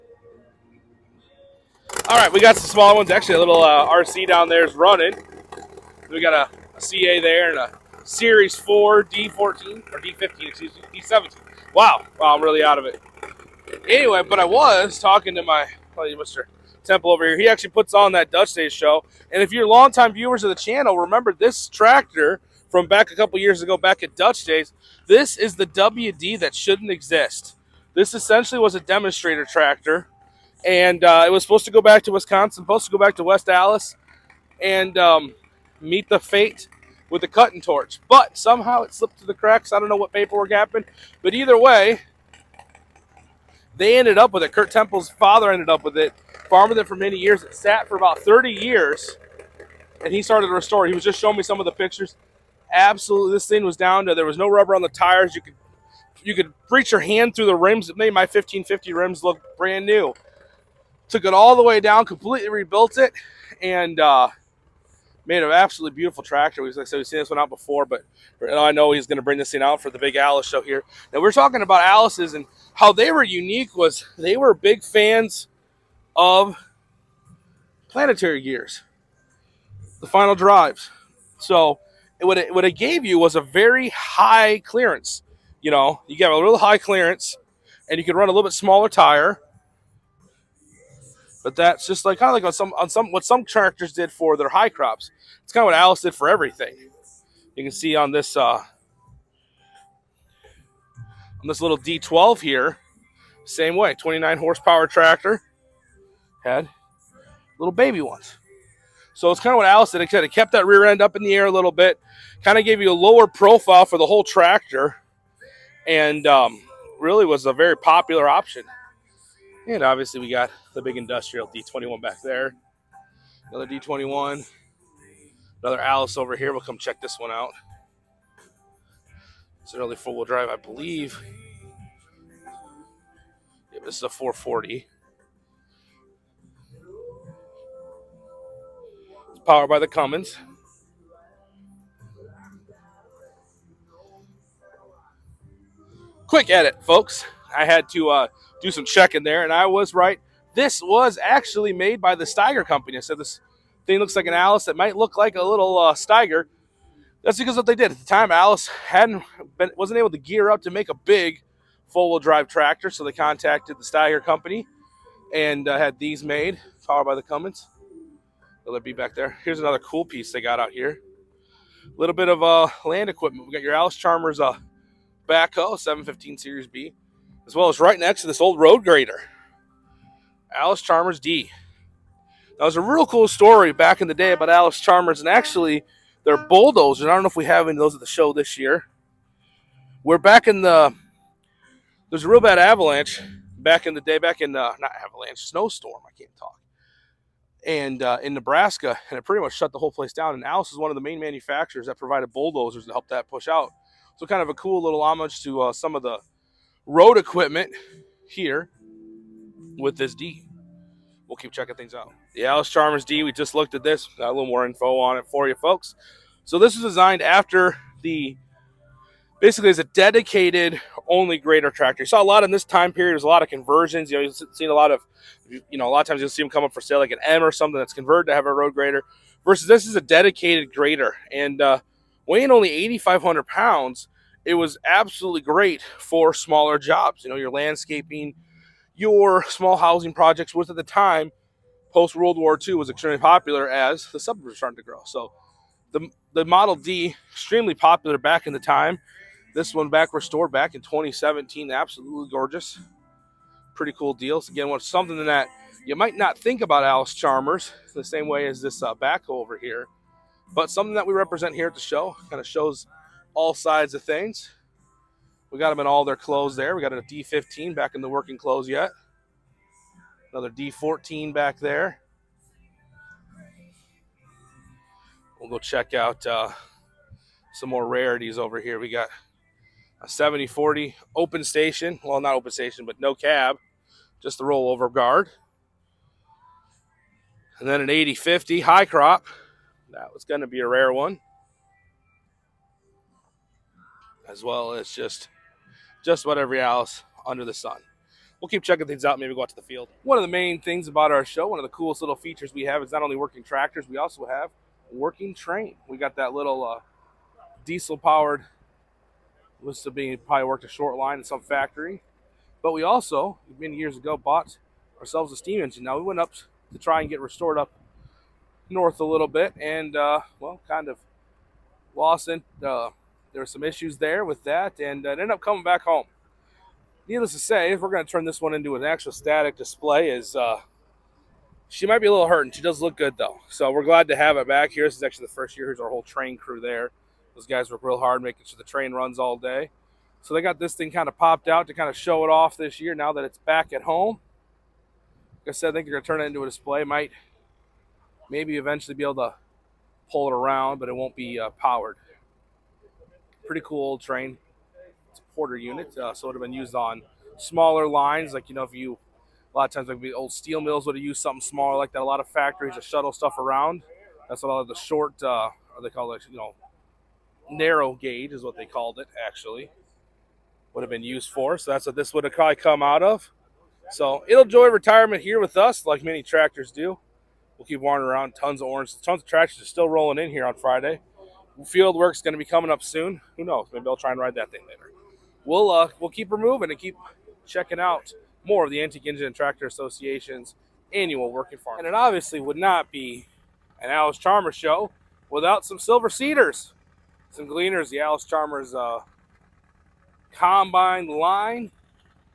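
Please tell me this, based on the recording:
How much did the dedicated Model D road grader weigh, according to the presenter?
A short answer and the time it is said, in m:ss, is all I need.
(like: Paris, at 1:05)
8,500 pounds, at 3:52.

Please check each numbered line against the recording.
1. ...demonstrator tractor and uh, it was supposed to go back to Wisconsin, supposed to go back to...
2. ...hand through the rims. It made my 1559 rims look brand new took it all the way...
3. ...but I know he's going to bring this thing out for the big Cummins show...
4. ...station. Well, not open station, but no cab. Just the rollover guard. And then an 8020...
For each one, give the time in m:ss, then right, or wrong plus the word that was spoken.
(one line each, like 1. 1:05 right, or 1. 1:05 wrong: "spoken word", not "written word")
1. 0:28 right
2. 0:56 wrong: "1550", not "1559"
3. 1:07 wrong: "Allis", not "Cummins"
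4. 4:41 wrong: "8050", not "8020".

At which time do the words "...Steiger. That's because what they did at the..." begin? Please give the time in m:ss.
2:35.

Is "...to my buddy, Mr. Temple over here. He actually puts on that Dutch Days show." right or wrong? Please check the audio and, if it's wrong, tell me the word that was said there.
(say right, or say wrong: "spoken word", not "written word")
right.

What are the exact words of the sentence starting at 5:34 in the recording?
This is actually the first year.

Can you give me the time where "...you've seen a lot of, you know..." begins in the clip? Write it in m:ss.
3:44.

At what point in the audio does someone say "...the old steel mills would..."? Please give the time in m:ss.
6:00.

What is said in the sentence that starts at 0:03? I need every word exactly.
Actually, a little uh, RC down there is running.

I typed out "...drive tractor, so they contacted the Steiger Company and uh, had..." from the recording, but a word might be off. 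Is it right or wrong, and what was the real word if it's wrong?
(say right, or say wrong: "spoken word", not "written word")
right.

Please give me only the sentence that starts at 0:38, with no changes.
But somehow it slipped through the cracks.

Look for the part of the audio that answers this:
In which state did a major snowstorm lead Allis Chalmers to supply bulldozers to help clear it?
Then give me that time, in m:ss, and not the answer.
3:18.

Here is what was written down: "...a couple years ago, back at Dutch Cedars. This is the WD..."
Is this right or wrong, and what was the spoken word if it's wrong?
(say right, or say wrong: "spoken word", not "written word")
wrong: "Days", not "Cedars".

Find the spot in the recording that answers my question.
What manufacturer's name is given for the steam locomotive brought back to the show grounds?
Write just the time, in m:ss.
5:55.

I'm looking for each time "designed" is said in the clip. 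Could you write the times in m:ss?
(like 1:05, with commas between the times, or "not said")
3:36.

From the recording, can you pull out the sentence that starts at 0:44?
Kurt Temple's father ended up with it, farmed it for many years.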